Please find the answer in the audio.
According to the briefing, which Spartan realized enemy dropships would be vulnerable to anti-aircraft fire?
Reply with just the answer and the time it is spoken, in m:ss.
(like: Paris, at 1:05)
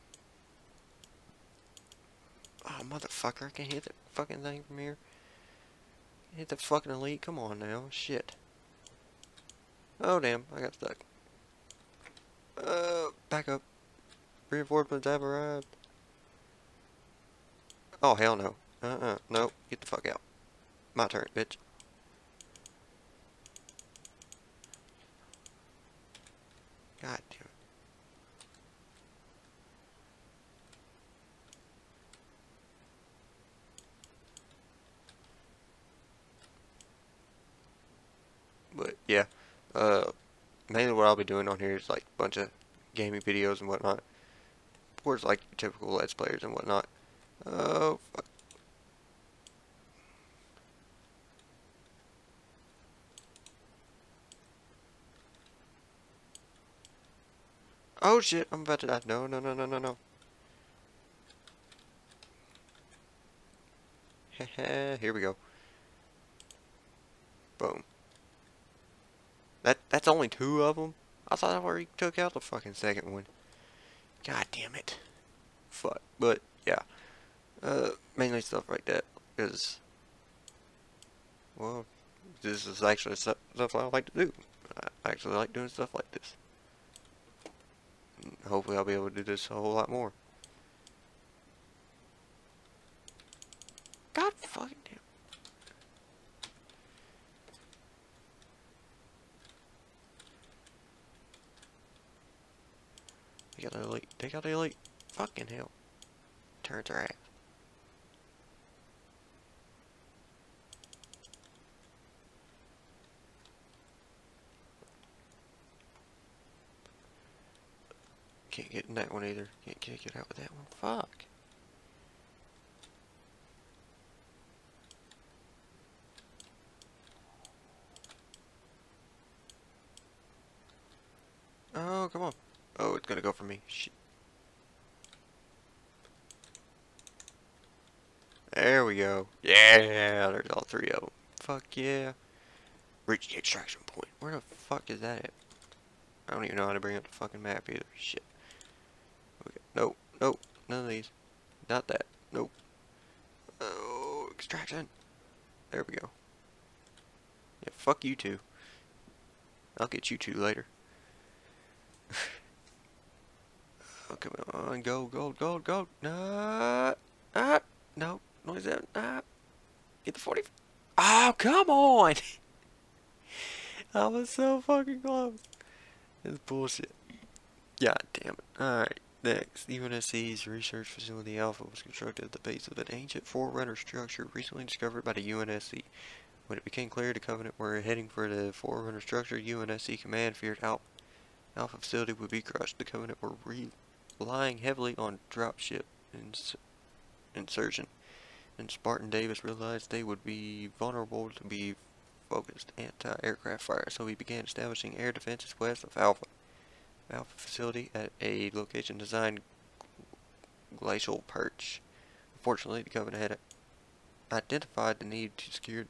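Davis, at 3:19.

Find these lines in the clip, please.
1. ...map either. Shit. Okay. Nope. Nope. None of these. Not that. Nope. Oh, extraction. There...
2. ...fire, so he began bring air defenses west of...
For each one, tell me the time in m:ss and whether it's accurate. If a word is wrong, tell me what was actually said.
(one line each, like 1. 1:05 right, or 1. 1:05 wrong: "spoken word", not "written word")
1. 2:27 right
2. 3:23 wrong: "establishing", not "bring".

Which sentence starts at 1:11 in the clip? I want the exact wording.
I thought I already took out the fucking second one.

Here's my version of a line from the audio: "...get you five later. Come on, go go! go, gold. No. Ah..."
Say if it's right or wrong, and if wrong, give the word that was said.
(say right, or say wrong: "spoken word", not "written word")
wrong: "two", not "five".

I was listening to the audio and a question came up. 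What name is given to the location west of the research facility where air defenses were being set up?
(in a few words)
Glacial Perch.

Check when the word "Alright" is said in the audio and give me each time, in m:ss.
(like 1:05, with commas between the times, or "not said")
2:58.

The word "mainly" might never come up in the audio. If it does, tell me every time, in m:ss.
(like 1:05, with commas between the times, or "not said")
0:40, 1:18.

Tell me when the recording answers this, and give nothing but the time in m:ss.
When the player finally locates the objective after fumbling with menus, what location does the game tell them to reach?
2:23.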